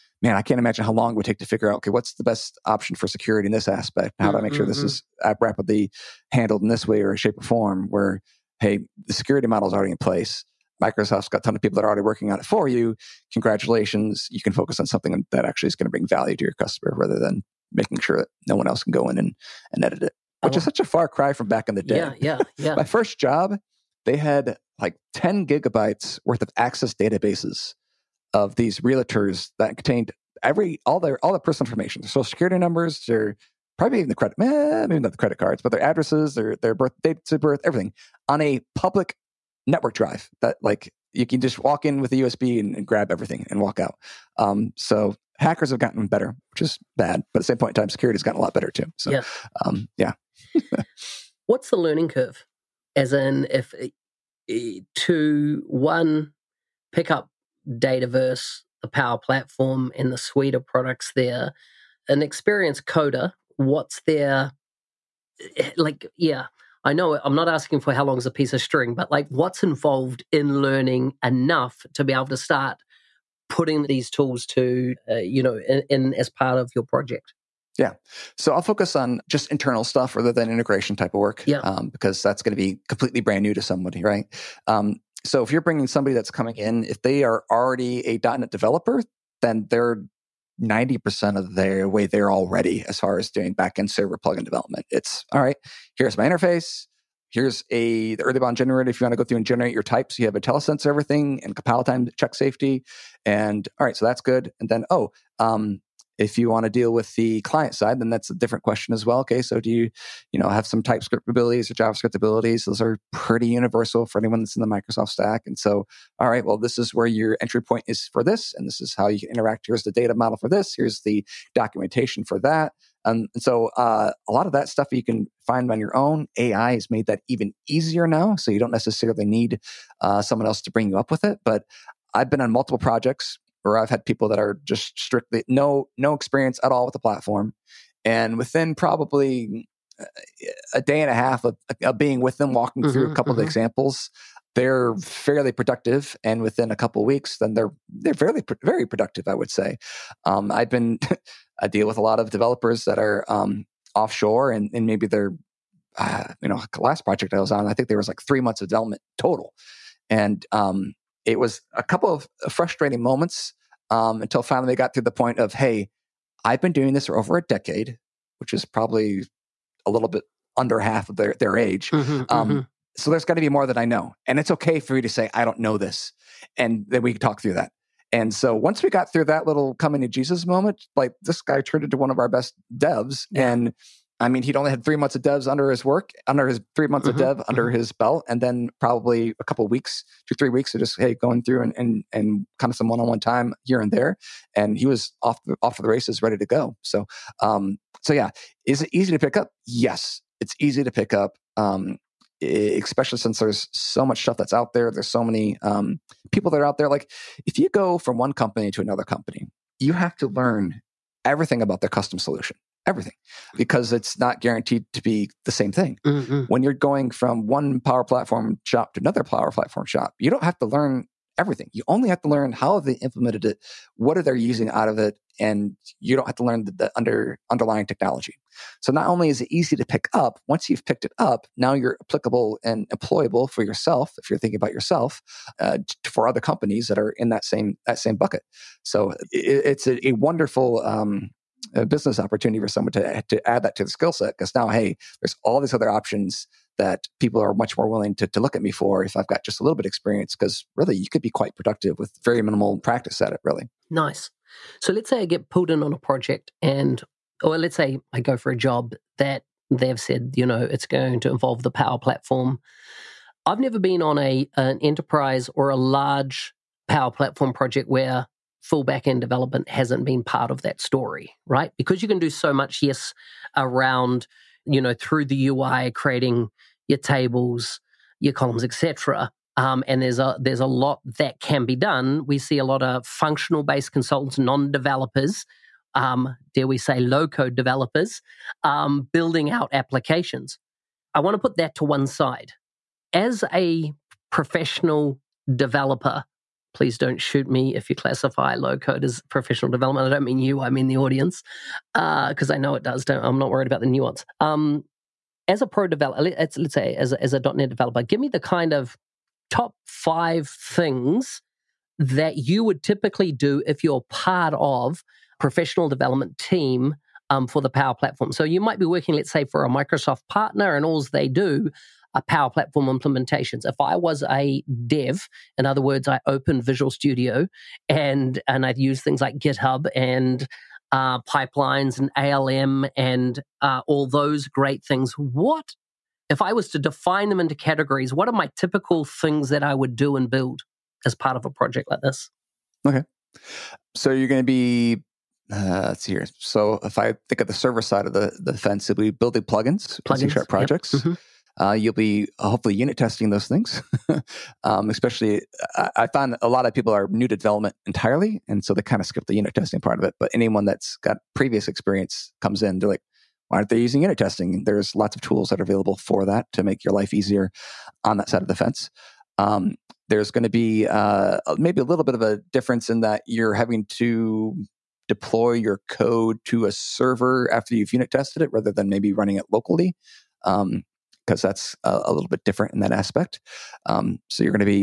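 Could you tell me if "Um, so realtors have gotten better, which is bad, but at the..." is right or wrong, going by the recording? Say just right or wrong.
wrong.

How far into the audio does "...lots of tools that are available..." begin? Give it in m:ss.
6:04.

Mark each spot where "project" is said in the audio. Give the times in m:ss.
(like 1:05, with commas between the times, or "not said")
1:16, 2:12, 2:37, 4:15, 4:27, 5:41, 5:50.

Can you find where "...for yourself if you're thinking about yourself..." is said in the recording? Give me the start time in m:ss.
3:53.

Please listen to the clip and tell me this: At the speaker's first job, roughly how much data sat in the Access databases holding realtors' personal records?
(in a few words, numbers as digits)
10 gigabytes.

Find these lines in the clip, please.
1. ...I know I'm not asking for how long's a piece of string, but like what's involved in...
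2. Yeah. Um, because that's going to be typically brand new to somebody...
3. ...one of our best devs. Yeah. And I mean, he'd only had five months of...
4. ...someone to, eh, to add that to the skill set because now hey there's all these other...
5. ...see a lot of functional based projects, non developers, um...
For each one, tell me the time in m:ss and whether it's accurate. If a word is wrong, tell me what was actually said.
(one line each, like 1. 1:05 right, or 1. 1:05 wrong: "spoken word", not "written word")
1. 1:06 right
2. 1:21 wrong: "completely", not "typically"
3. 3:01 wrong: "three", not "five"
4. 4:02 right
5. 4:42 wrong: "consultants", not "projects".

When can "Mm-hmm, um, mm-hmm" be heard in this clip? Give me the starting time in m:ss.
2:51.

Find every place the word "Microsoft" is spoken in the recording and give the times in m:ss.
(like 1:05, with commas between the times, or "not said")
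0:10, 1:54, 5:19.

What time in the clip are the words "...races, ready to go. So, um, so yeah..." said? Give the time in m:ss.
3:15.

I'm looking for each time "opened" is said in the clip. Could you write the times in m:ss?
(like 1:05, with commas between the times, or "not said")
5:26.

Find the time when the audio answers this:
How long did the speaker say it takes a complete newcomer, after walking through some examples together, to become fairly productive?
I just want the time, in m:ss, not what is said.
2:20.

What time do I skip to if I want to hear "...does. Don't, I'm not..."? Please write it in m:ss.
5:02.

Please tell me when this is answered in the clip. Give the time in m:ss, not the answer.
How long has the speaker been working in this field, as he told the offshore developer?
2:47.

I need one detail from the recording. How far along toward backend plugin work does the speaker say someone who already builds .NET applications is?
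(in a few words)
90%.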